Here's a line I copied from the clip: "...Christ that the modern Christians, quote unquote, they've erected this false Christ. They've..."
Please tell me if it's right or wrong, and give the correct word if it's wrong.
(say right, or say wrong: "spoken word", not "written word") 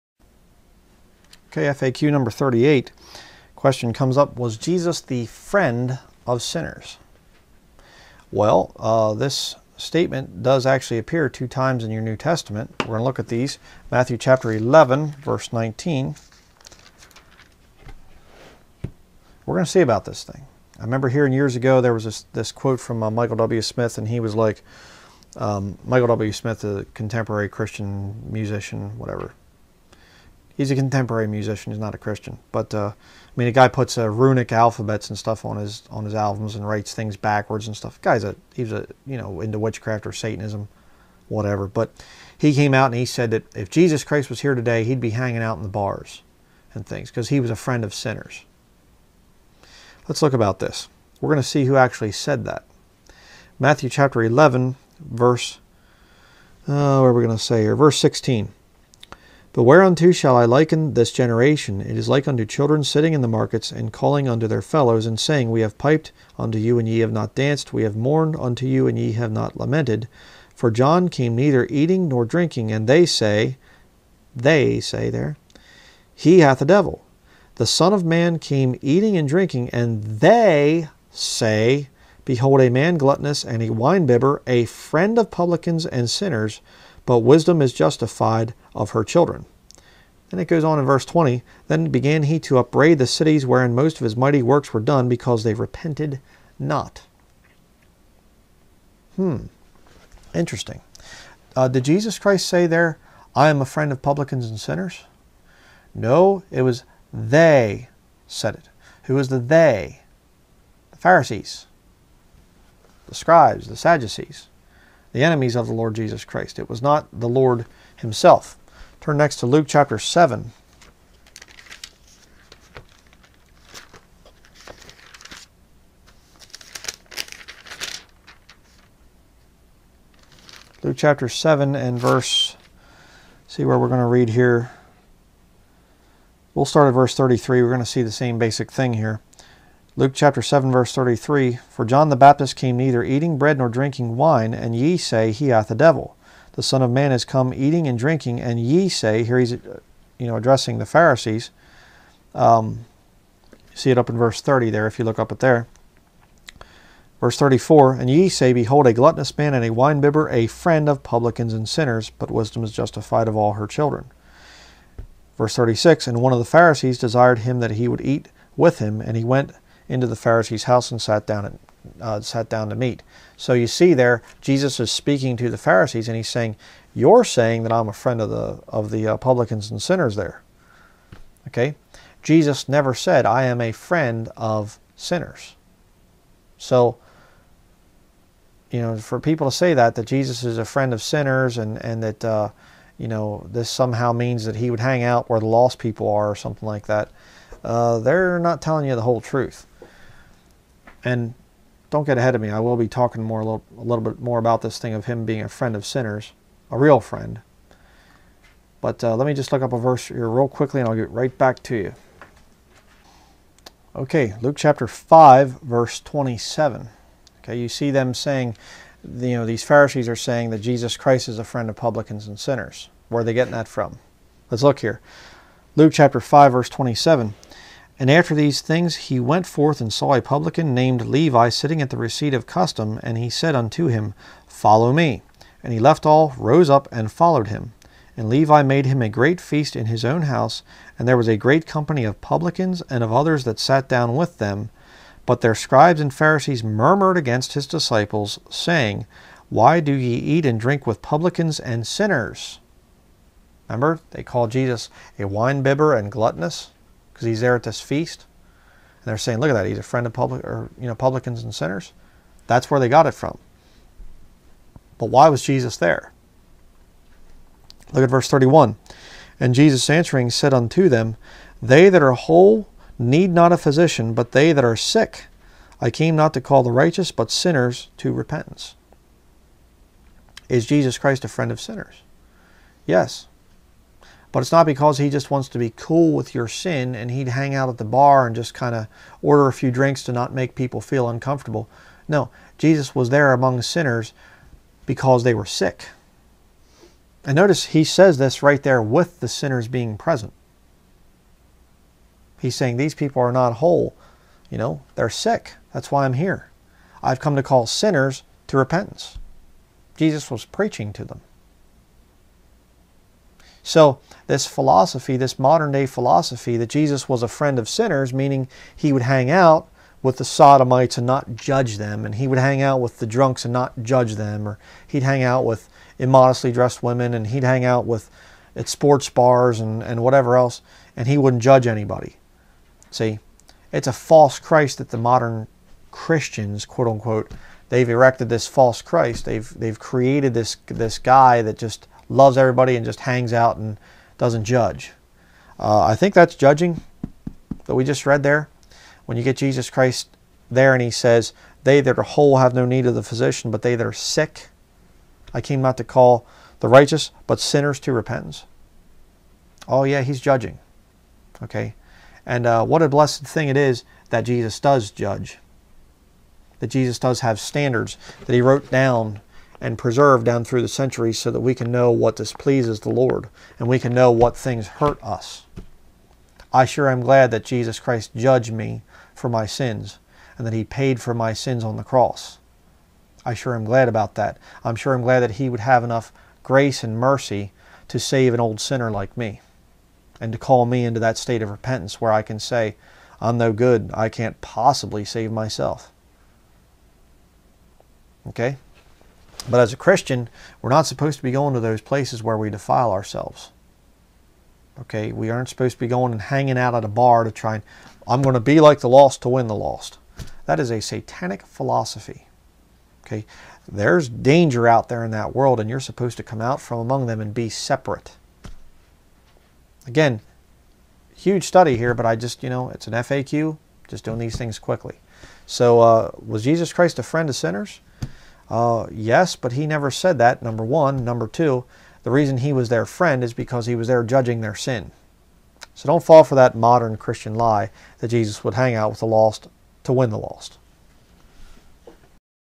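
right.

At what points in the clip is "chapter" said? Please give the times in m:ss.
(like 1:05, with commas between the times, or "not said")
0:14, 0:53, 1:59, 2:10, 2:20, 3:34, 3:45.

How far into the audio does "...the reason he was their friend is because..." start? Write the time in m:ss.
7:12.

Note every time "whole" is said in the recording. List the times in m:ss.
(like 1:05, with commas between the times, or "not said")
3:19, 4:32, 5:03, 5:52.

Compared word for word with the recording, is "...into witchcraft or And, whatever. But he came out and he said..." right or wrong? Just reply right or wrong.
wrong.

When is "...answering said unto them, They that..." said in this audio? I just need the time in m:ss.
4:29.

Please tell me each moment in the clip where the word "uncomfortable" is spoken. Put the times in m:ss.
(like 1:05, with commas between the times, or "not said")
4:51.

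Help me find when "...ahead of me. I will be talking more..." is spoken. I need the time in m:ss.
3:22.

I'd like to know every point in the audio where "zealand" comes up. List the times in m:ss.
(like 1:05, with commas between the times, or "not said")
not said.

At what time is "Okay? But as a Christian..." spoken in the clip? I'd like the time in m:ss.
6:38.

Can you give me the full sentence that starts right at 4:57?
And notice he says this right there with the sinners being present.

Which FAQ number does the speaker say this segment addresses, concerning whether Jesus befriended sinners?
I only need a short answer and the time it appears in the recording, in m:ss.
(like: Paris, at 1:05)
38, at 0:02.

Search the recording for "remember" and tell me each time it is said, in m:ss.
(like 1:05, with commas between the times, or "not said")
0:20, 4:13.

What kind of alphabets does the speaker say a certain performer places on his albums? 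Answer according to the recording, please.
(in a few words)
runic.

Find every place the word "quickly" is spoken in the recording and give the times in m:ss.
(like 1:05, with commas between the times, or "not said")
3:30, 7:04.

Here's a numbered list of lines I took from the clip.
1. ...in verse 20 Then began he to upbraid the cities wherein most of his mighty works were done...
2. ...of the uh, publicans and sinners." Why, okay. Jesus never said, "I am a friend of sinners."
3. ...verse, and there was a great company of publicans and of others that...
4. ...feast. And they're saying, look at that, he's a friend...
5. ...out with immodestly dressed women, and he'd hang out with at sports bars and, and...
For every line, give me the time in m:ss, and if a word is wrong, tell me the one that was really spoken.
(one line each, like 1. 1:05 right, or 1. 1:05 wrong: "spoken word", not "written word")
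1. 1:30 right
2. 2:58 wrong: "There", not "Why"
3. 4:00 wrong: "house", not "verse"
4. 4:17 right
5. 5:25 right.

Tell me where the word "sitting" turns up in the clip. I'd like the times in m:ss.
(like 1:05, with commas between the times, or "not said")
1:02, 3:51.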